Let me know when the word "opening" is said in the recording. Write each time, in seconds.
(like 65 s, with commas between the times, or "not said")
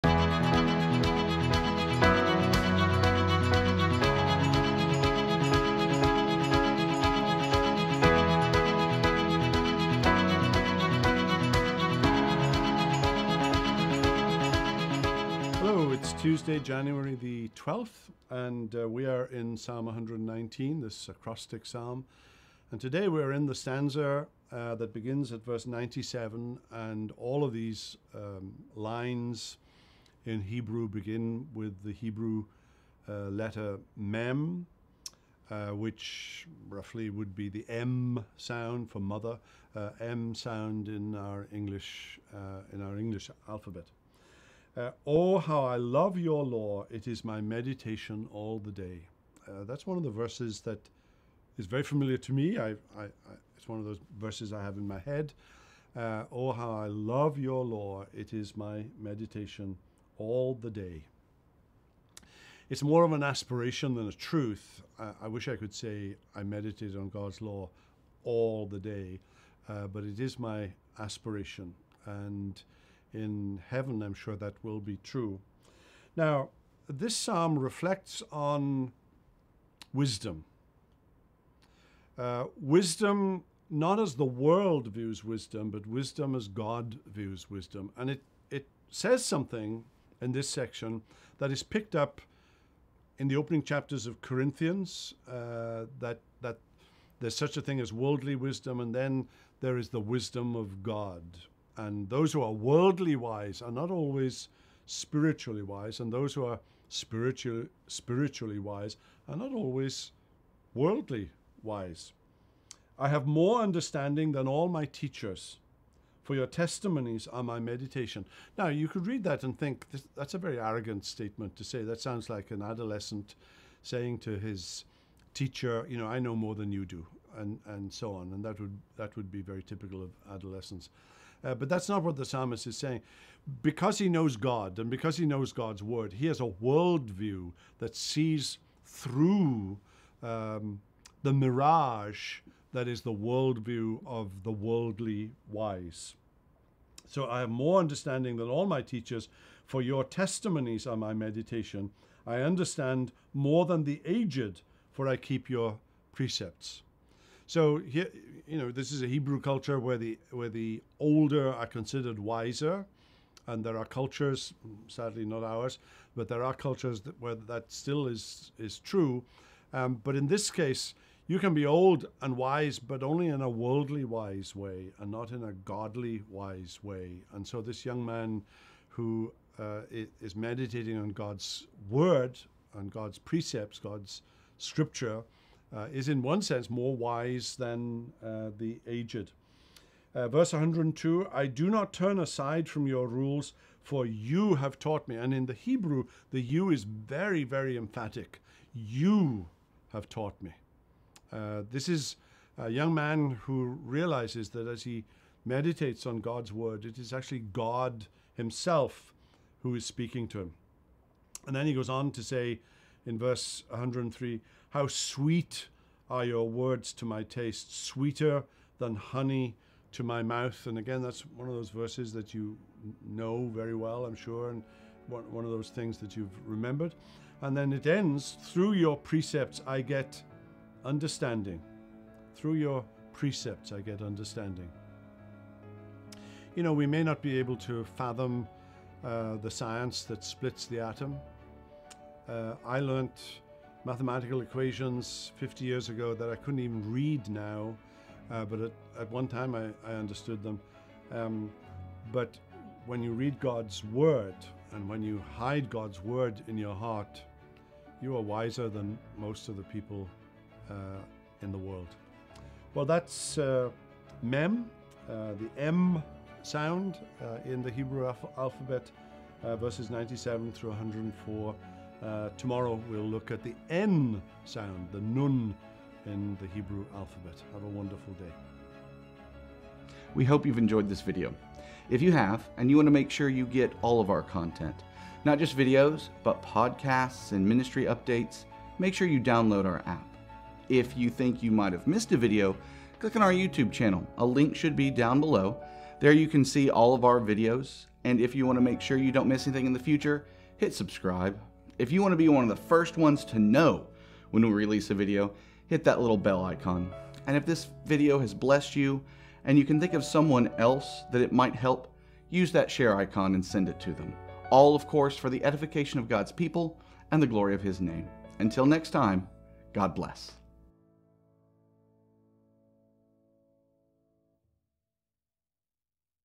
93 s.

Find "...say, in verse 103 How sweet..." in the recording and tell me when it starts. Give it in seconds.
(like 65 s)
212 s.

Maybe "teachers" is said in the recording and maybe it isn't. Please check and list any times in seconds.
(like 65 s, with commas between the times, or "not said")
114 s, 125 s, 148 s.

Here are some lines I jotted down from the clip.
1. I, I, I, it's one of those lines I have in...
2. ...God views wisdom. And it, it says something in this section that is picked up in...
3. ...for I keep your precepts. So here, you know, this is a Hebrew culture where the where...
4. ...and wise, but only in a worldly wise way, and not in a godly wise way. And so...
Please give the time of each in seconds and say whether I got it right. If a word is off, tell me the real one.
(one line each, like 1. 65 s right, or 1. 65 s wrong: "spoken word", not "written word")
1. 52 s wrong: "verses", not "lines"
2. 86 s right
3. 154 s right
4. 172 s right.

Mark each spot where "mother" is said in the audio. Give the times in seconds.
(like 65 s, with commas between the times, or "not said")
38 s.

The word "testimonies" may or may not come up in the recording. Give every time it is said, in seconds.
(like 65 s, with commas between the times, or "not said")
116 s, 150 s.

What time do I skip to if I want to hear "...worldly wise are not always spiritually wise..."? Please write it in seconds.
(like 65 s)
102 s.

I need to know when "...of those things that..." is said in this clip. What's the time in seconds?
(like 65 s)
225 s.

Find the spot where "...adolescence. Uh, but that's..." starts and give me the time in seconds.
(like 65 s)
130 s.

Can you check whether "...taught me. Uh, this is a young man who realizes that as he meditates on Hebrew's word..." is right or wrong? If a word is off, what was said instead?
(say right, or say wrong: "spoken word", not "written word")
wrong: "God", not "Hebrew".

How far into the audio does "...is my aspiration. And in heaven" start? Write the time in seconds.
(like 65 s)
70 s.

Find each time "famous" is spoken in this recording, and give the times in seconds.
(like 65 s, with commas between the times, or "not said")
not said.